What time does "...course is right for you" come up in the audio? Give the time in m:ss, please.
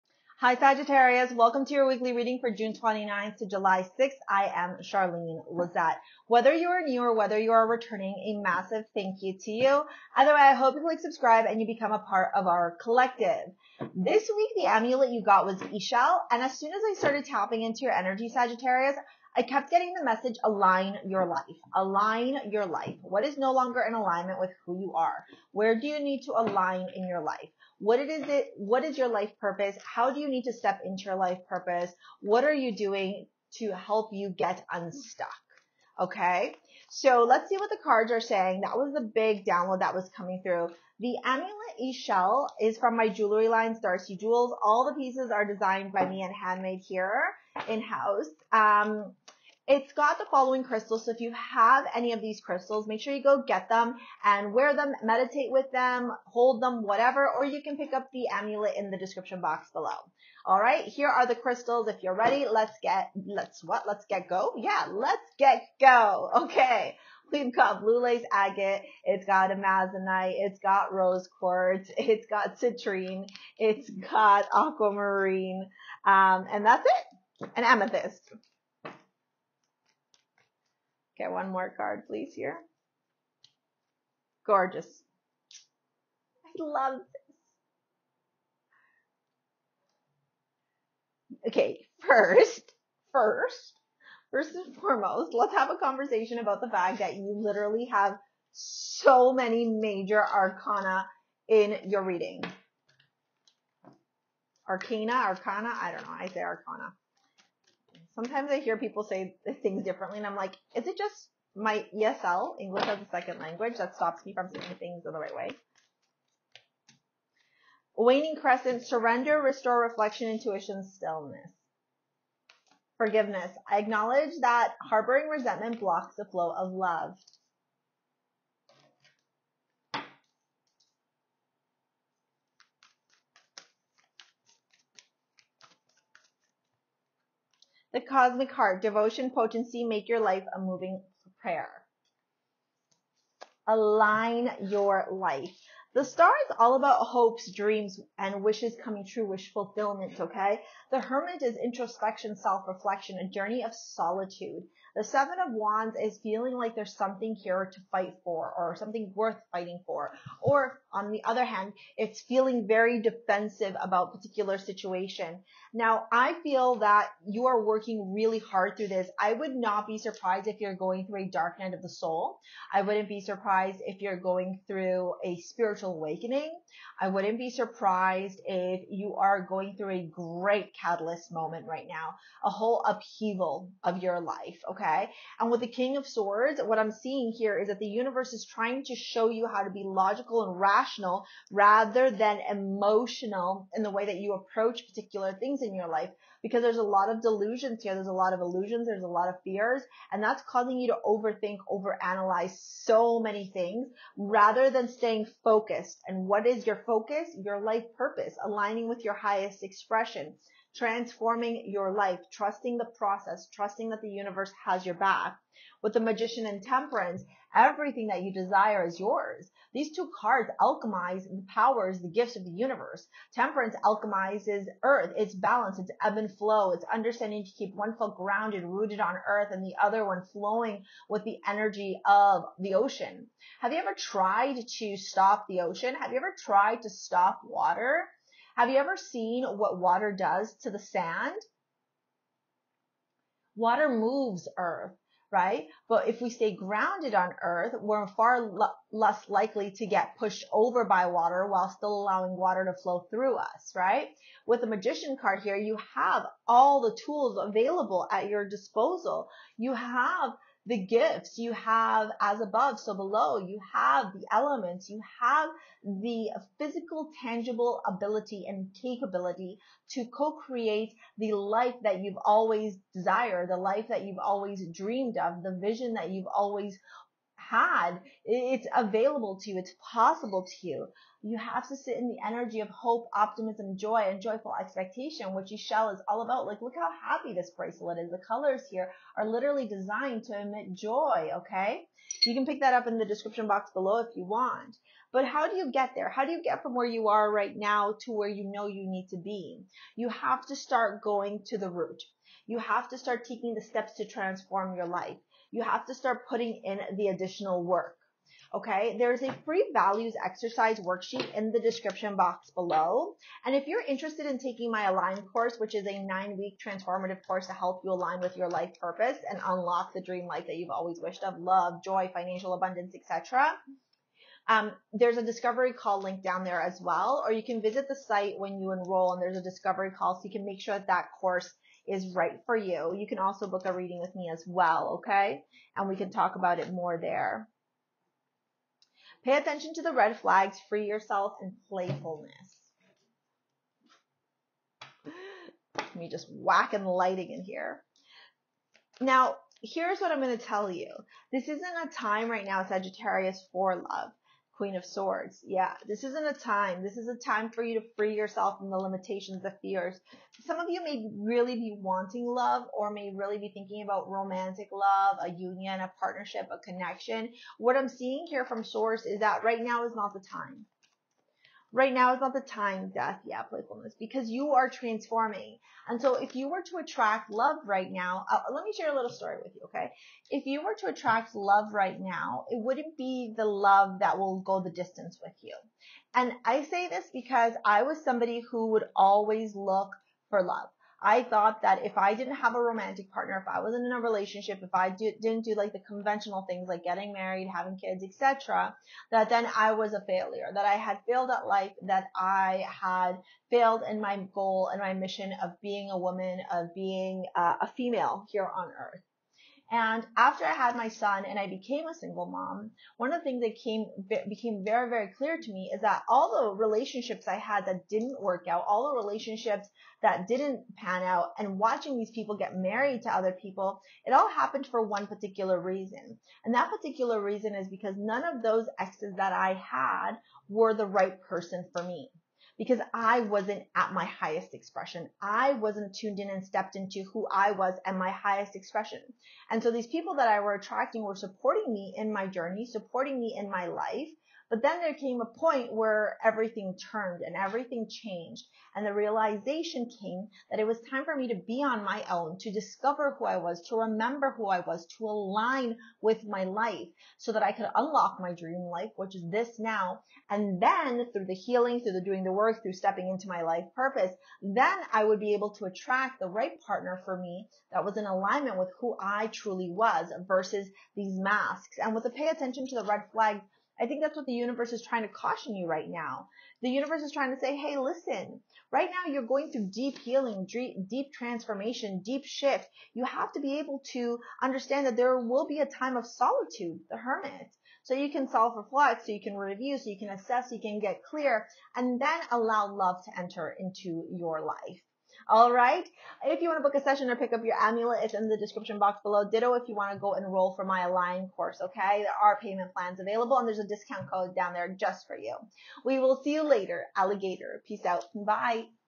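5:31.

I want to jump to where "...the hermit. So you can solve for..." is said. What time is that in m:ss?
8:06.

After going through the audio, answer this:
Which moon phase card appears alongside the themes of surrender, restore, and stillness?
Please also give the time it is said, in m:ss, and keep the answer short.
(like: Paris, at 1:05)
Waning crescent, at 1:57.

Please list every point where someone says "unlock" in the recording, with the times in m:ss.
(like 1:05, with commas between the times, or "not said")
5:19, 7:37.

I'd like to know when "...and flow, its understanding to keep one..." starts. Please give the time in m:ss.
3:46.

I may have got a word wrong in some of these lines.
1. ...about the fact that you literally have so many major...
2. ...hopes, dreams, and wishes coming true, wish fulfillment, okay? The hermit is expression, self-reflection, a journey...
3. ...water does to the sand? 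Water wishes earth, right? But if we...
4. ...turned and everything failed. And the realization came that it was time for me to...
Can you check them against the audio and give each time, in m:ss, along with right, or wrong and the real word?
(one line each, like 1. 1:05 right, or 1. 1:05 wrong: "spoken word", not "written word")
1. 1:36 right
2. 2:27 wrong: "introspection", not "expression"
3. 3:59 wrong: "moves", not "wishes"
4. 7:26 wrong: "changed", not "failed".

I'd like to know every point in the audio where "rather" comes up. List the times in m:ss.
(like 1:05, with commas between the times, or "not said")
3:11, 3:24.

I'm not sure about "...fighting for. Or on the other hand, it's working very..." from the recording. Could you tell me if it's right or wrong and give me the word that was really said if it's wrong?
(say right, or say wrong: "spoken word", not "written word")
wrong: "feeling", not "working".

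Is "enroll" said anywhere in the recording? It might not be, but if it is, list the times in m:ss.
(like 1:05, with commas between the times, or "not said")
5:28, 8:20.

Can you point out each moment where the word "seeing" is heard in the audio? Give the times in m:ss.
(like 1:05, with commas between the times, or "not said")
3:06, 6:07.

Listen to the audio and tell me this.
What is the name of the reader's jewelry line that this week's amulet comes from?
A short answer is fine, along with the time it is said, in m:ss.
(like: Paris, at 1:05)
Starsea Jewels, at 0:43.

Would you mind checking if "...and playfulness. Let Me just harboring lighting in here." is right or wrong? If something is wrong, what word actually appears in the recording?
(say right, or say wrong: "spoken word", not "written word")
wrong: "whacking", not "harboring".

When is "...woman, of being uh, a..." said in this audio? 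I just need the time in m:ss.
6:45.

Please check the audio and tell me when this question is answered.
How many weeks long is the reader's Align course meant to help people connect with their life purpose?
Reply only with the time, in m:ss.
5:16.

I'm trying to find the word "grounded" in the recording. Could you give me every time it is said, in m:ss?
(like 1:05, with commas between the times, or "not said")
3:48, 4:06.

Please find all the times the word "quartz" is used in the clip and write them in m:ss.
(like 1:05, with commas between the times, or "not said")
1:11.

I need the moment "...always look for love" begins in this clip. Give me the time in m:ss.
6:28.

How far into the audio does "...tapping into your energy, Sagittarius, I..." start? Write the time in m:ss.
0:17.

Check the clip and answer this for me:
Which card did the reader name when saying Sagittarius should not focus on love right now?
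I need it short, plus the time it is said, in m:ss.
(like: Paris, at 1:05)
Queen of Swords, at 5:54.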